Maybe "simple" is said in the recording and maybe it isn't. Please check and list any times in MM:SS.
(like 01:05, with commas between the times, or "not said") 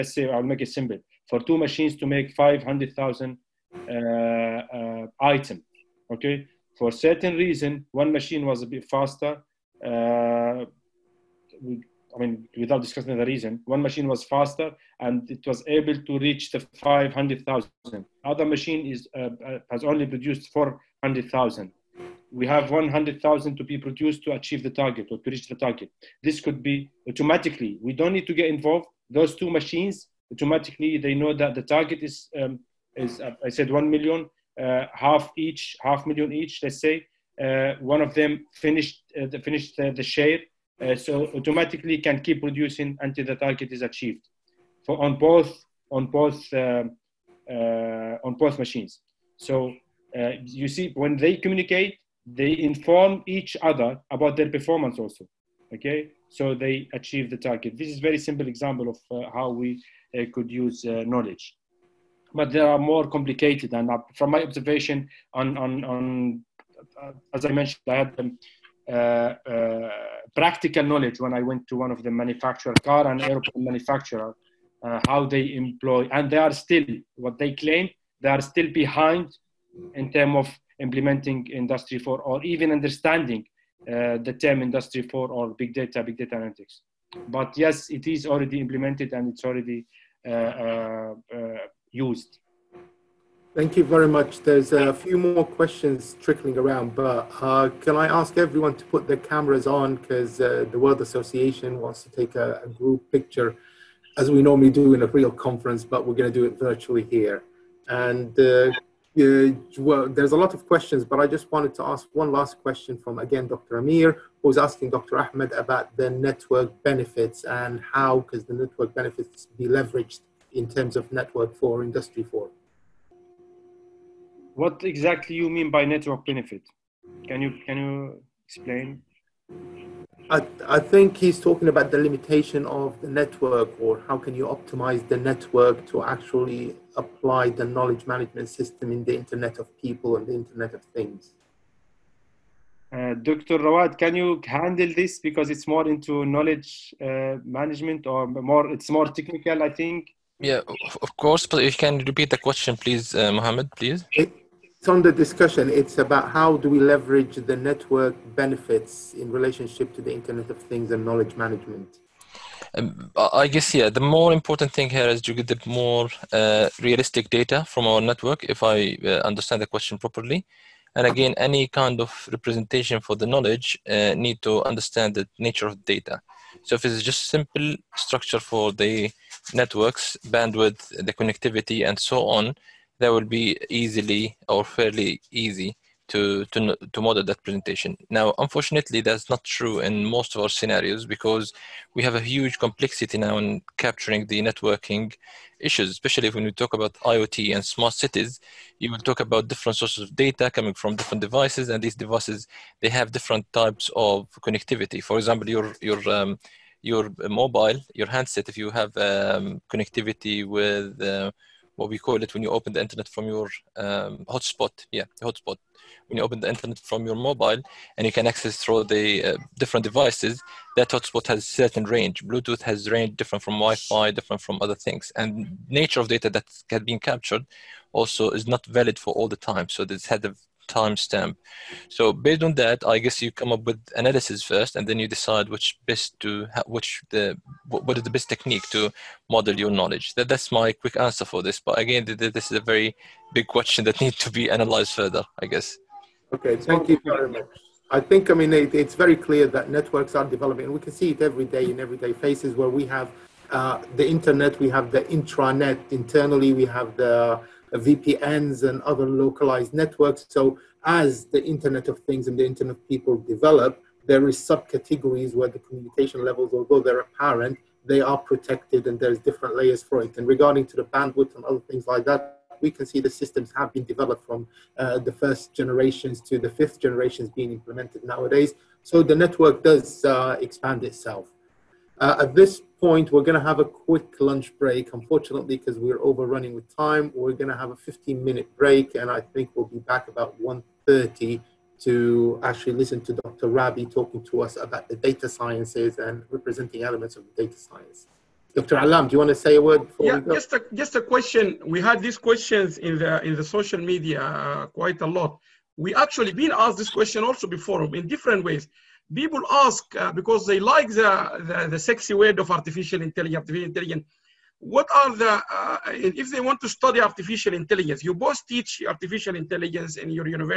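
00:00, 00:58, 02:57.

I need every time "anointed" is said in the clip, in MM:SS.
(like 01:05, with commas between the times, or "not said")
not said.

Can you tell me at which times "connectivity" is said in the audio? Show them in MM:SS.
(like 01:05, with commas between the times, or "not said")
03:01, 03:24, 03:29.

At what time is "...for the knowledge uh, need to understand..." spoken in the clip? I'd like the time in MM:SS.
02:52.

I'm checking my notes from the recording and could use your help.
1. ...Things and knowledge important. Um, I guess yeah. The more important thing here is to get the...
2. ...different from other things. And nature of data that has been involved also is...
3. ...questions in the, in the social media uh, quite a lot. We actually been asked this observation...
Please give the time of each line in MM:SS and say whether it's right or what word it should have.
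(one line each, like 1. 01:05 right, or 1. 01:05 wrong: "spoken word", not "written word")
1. 02:40 wrong: "management", not "important"
2. 03:44 wrong: "captured", not "involved"
3. 05:02 wrong: "question", not "observation".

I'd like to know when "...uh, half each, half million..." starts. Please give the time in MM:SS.
00:34.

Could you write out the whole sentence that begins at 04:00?
That that's my quick answer for this.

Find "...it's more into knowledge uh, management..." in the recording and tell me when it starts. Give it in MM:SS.
02:25.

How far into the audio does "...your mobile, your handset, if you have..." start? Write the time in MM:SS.
03:26.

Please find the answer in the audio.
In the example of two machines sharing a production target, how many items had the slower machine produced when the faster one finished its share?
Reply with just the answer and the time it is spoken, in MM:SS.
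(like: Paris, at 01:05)
400,000, at 00:20.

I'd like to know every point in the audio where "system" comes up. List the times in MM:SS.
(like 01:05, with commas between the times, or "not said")
02:18, 04:33.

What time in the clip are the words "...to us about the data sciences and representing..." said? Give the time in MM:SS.
04:54.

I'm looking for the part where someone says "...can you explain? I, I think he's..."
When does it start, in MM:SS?
02:07.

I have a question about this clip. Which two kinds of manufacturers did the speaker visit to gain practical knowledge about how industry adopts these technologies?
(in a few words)
car and airplane.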